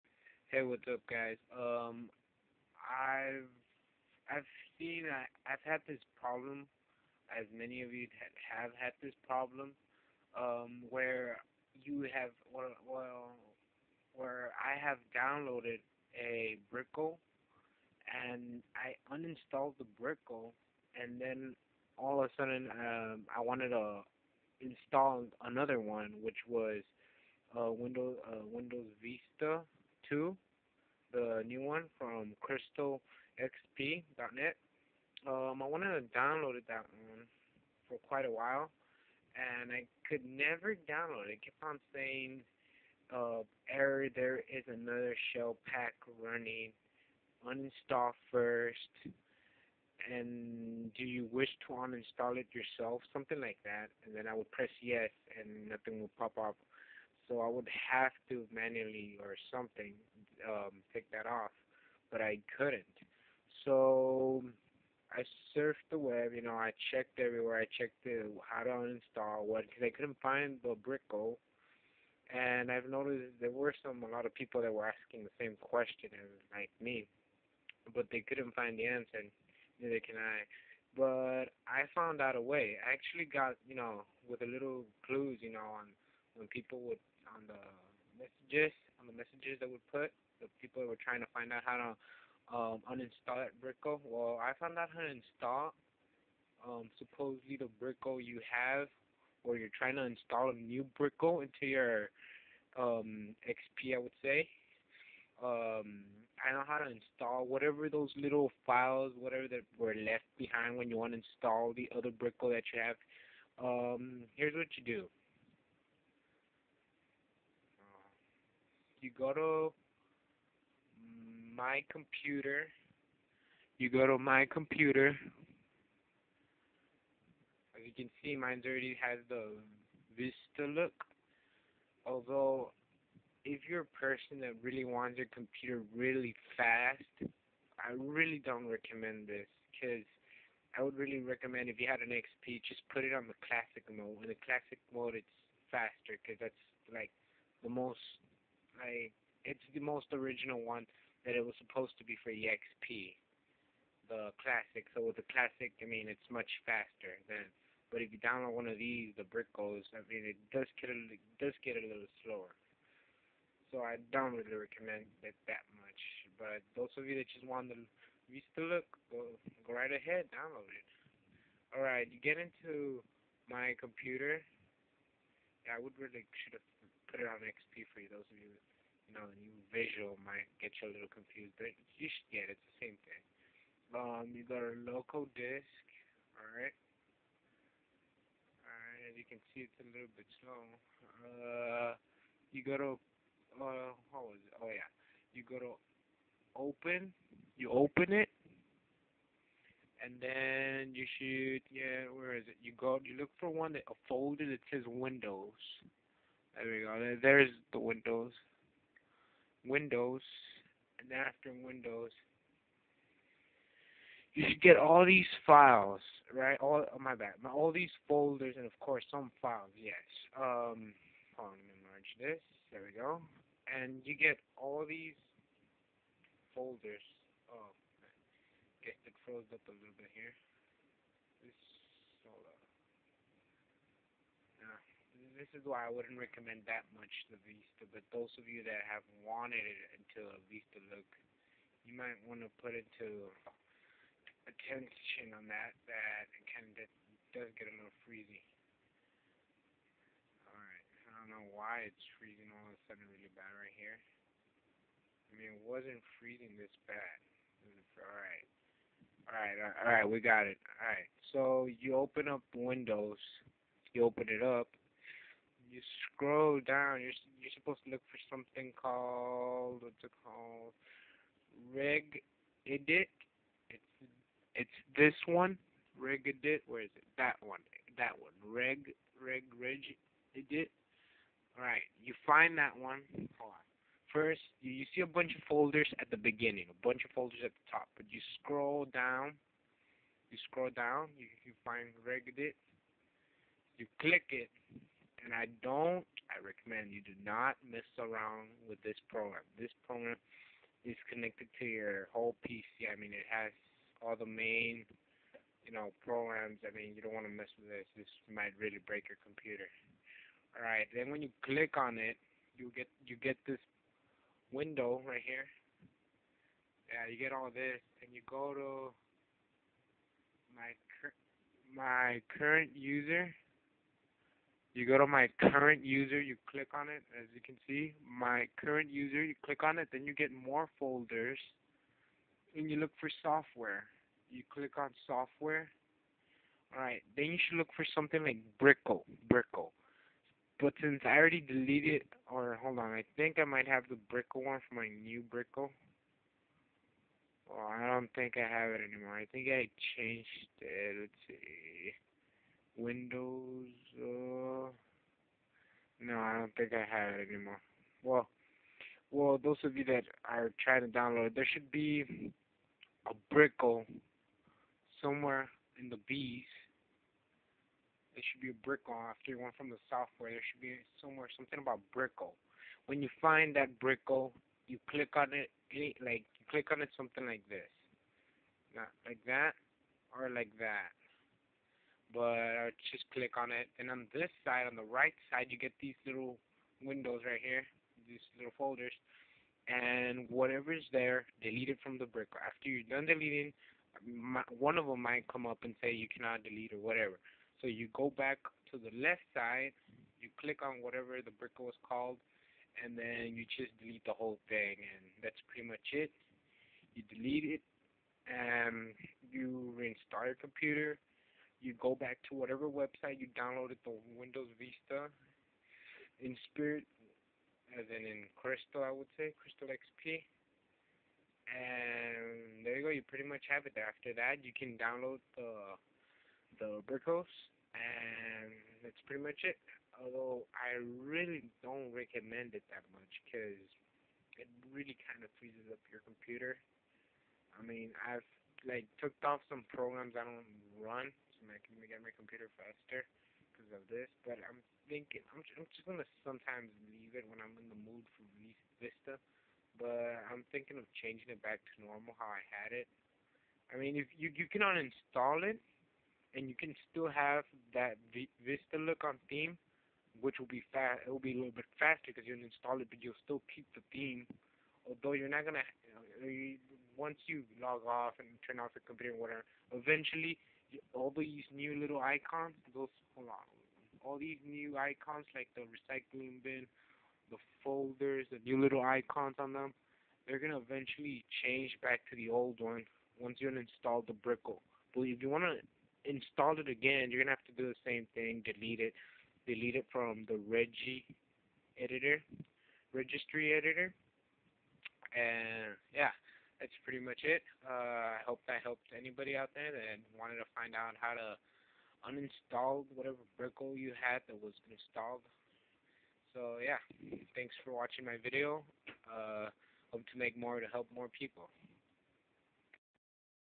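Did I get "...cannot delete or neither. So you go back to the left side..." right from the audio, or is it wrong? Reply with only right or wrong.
wrong.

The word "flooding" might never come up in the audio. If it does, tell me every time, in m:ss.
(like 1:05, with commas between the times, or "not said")
not said.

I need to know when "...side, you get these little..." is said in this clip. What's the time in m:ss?
6:25.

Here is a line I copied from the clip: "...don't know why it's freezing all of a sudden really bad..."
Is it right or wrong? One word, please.
right.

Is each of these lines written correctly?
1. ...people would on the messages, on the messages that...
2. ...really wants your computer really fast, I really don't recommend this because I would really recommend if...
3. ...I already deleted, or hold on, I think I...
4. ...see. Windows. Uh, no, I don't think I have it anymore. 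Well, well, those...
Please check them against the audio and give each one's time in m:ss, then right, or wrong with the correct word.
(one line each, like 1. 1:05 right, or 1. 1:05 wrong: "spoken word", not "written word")
1. 1:26 right
2. 2:14 right
3. 5:41 right
4. 5:51 right.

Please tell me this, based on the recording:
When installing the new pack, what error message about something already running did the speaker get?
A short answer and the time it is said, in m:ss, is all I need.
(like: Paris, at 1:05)
another shell pack running, at 0:44.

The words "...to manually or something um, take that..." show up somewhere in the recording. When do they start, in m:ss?
0:58.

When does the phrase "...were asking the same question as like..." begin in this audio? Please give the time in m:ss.
1:14.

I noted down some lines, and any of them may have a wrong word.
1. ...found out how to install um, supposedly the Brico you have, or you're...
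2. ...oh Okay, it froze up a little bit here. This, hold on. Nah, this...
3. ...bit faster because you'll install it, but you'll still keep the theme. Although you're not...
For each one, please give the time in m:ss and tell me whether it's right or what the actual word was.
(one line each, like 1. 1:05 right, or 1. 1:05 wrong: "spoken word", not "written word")
1. 1:34 right
2. 3:47 right
3. 7:41 right.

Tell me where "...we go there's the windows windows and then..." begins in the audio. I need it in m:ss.
3:26.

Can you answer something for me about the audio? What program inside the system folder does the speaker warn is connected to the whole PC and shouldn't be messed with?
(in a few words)
Regedit.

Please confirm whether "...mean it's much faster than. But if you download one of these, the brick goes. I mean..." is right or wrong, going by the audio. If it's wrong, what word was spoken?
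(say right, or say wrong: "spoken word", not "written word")
right.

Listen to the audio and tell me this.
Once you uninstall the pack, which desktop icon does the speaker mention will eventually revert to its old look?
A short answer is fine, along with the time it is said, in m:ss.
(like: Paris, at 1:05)
recycling bin, at 7:55.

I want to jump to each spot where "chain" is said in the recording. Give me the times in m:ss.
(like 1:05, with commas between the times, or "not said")
not said.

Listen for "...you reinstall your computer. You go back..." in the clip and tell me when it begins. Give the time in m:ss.
6:49.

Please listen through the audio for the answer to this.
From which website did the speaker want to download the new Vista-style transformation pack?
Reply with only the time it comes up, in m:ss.
0:32.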